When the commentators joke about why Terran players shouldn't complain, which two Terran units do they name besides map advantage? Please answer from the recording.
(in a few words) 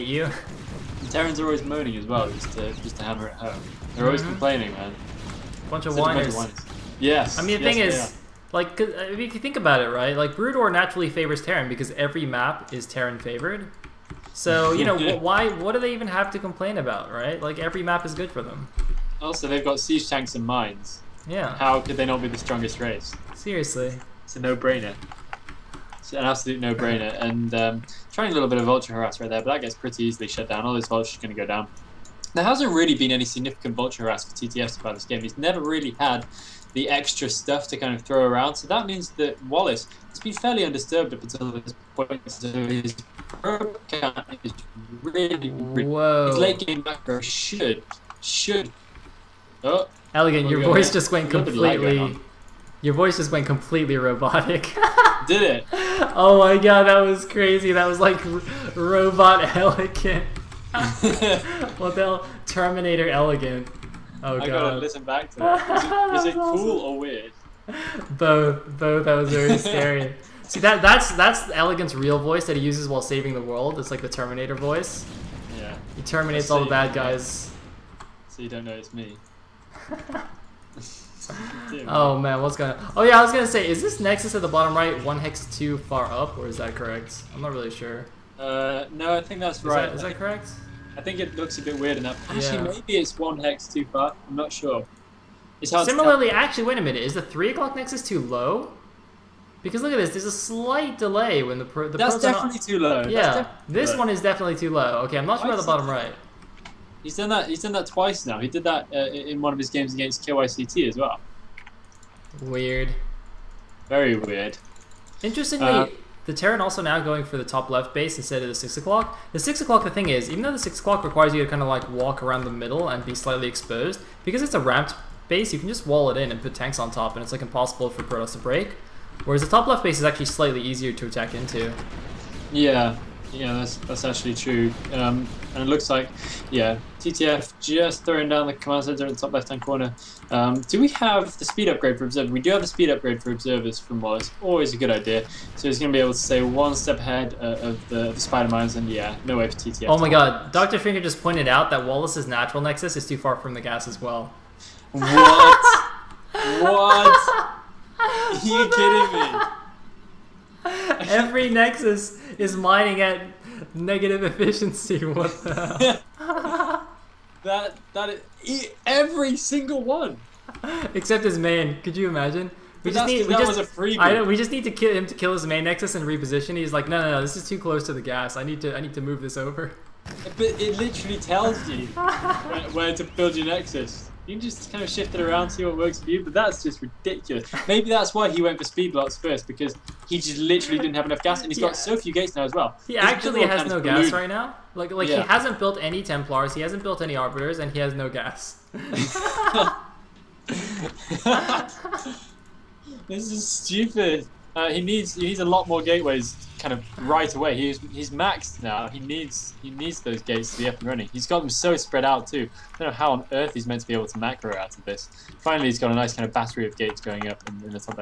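Siege tanks and mines.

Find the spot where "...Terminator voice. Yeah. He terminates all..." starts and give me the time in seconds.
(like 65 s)
74 s.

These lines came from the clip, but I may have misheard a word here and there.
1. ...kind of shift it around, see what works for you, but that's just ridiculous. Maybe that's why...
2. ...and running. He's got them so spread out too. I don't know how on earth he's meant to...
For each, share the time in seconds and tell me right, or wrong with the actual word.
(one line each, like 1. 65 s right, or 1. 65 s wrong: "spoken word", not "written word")
1. 184 s right
2. 210 s right.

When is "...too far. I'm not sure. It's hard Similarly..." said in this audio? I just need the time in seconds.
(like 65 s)
93 s.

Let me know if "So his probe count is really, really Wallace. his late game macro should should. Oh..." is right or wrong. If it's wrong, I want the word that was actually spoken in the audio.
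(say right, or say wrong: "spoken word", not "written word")
wrong: "Whoa", not "Wallace".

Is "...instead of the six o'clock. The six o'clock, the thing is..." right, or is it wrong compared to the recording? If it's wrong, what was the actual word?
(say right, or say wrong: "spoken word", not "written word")
right.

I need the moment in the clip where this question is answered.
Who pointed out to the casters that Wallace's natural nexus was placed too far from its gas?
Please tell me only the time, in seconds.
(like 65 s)
150 s.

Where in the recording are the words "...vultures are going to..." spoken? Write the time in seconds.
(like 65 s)
30 s.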